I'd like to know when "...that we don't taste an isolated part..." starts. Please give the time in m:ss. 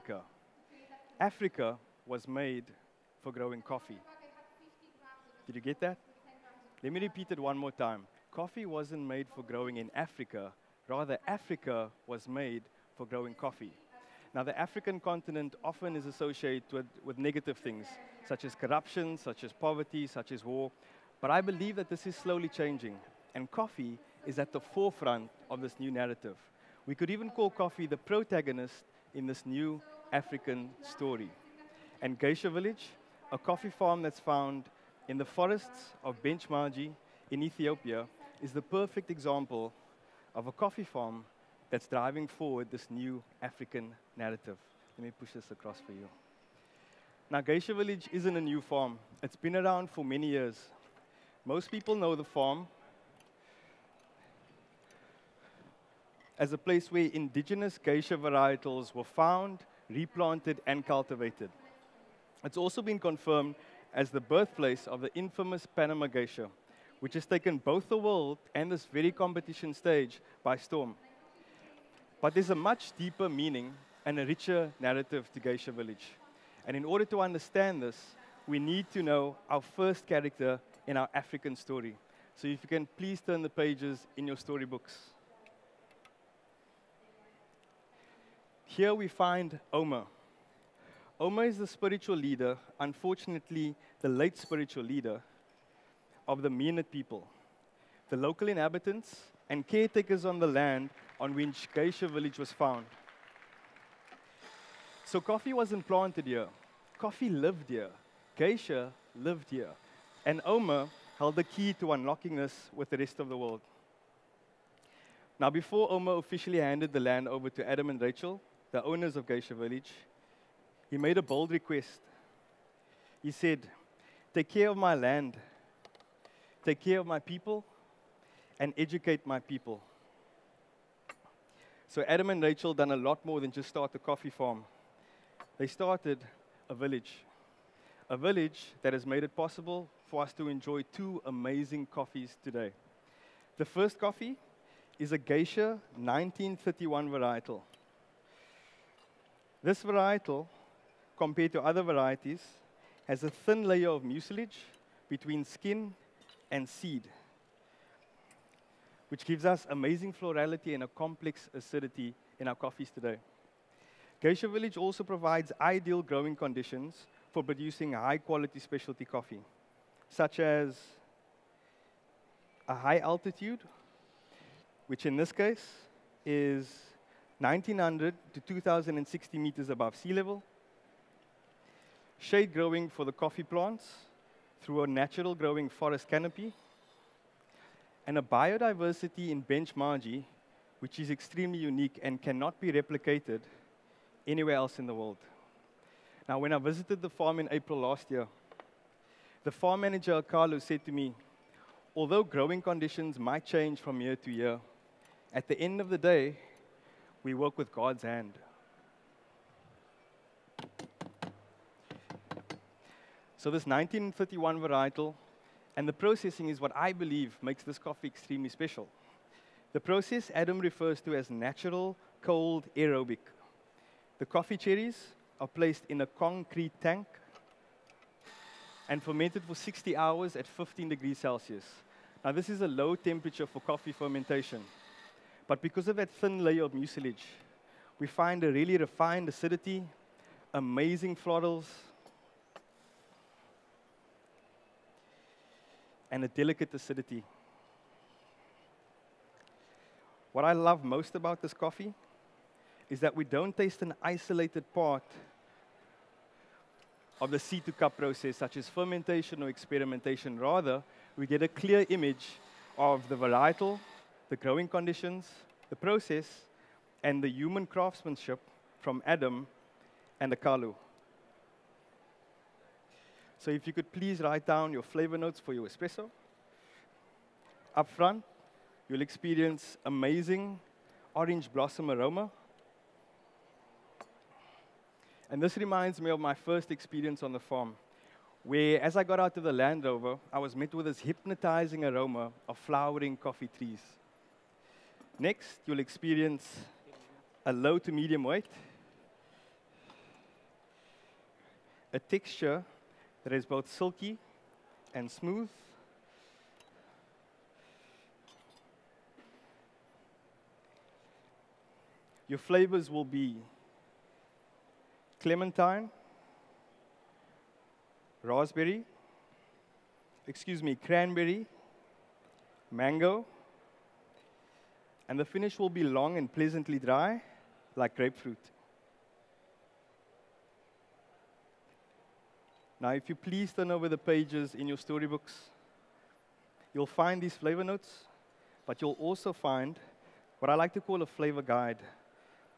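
4:12.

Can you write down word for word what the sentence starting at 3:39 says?
The process Adam refers to as natural, cold, aerobic.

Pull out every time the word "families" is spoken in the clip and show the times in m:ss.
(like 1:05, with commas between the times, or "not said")
not said.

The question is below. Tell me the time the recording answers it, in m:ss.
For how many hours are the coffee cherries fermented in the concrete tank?
3:49.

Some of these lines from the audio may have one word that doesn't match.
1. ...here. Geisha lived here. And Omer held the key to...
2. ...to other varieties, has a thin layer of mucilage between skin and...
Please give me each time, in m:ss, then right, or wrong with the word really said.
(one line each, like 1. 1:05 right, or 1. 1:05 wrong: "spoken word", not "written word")
1. 1:47 right
2. 2:31 right.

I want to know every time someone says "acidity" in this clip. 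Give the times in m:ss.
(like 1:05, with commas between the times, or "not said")
2:41, 3:59, 4:06.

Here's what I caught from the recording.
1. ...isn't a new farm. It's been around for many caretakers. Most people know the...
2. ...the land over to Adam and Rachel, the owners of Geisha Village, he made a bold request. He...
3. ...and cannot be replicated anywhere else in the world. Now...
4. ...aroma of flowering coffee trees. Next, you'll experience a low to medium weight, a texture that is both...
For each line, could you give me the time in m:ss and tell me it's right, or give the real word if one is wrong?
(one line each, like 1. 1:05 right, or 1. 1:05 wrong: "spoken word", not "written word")
1. 0:48 wrong: "years", not "caretakers"
2. 1:56 right
3. 3:12 right
4. 4:51 right.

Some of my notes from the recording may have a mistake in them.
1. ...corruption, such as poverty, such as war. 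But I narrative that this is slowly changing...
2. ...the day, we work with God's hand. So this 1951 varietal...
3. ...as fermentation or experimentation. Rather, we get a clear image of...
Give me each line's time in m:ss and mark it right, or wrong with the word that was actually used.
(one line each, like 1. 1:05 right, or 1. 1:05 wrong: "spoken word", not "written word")
1. 0:18 wrong: "believe", not "narrative"
2. 3:25 right
3. 4:18 right.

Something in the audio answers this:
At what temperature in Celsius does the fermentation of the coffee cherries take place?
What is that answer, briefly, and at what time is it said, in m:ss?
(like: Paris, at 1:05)
15 degrees, at 3:50.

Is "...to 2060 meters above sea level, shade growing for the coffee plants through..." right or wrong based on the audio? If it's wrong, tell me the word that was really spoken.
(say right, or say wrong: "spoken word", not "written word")
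right.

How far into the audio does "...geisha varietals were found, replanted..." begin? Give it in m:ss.
0:57.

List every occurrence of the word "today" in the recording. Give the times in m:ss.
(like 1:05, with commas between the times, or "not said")
2:22, 2:42.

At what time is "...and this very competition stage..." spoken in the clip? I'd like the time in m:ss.
1:08.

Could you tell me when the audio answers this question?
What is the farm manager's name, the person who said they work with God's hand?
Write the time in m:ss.
3:20.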